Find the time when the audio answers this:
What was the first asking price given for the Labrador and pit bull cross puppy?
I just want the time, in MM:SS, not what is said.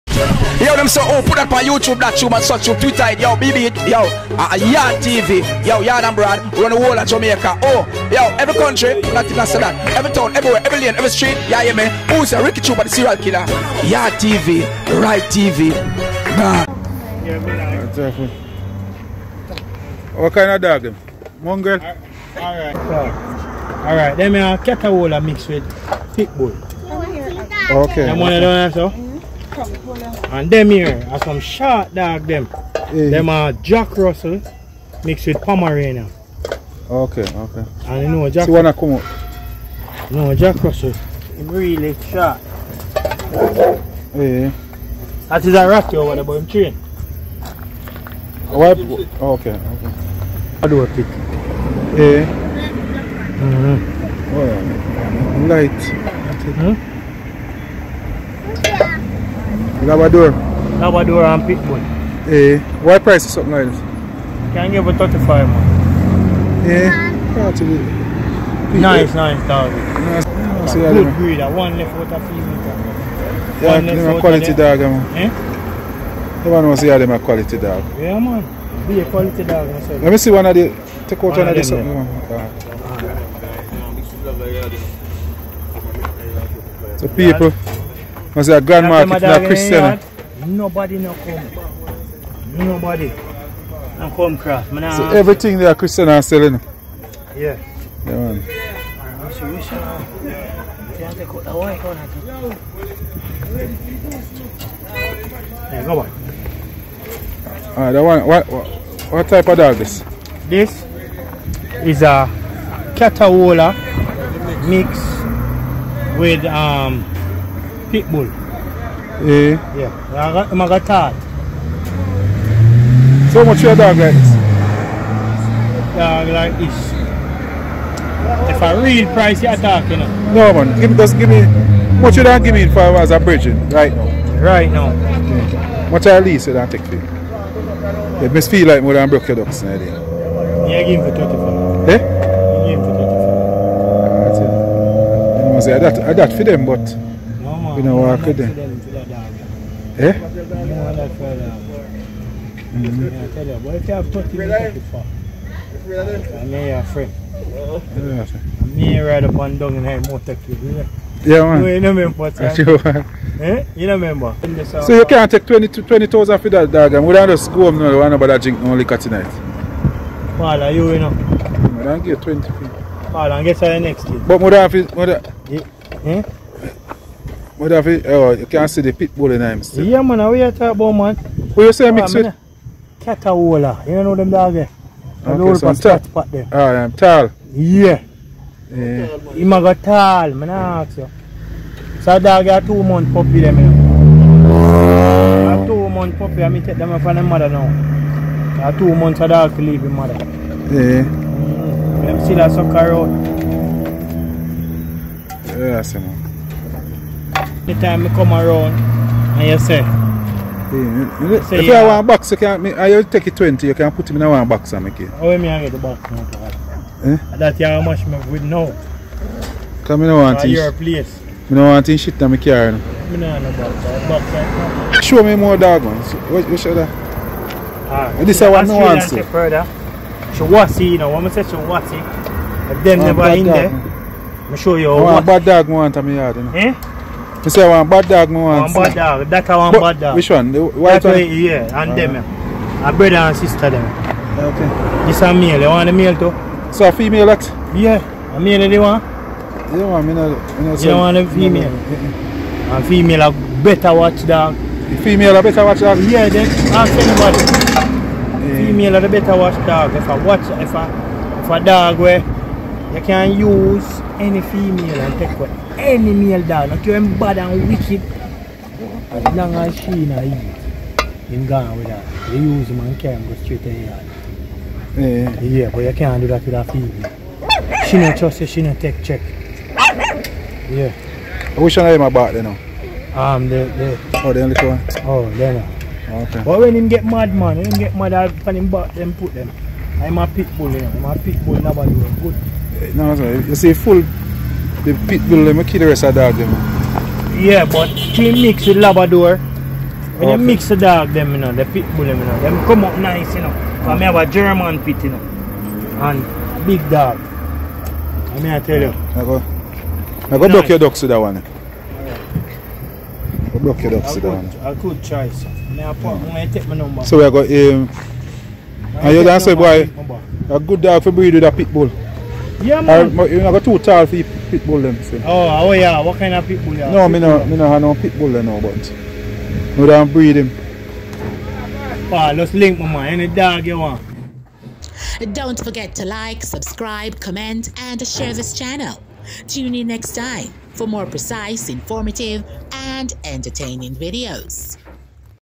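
01:04.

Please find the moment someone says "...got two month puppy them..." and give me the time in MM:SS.
03:12.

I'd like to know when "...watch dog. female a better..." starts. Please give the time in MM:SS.
04:13.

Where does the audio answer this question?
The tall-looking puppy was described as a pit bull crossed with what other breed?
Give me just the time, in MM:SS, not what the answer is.
01:52.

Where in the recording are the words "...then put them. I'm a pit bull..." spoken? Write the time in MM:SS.
04:48.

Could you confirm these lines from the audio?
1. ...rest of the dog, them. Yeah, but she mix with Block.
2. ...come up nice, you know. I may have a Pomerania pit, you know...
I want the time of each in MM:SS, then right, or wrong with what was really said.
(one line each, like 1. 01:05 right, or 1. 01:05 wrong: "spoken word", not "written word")
1. 04:55 wrong: "Labrador", not "Block"
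2. 05:02 wrong: "German", not "Pomerania".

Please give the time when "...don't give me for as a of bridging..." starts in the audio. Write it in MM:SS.
02:12.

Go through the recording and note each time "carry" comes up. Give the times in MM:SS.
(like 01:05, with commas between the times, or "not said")
03:42, 04:32.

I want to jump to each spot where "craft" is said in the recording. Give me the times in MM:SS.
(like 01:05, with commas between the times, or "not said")
01:34.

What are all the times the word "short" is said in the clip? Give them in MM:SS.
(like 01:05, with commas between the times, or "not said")
00:31, 00:41.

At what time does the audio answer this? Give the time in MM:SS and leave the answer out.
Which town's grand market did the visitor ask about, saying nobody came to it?
01:29.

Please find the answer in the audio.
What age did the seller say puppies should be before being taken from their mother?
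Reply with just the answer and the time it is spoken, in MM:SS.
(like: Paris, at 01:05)
2 months, at 03:18.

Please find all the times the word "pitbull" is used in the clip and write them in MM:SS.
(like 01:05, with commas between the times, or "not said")
01:01, 01:57.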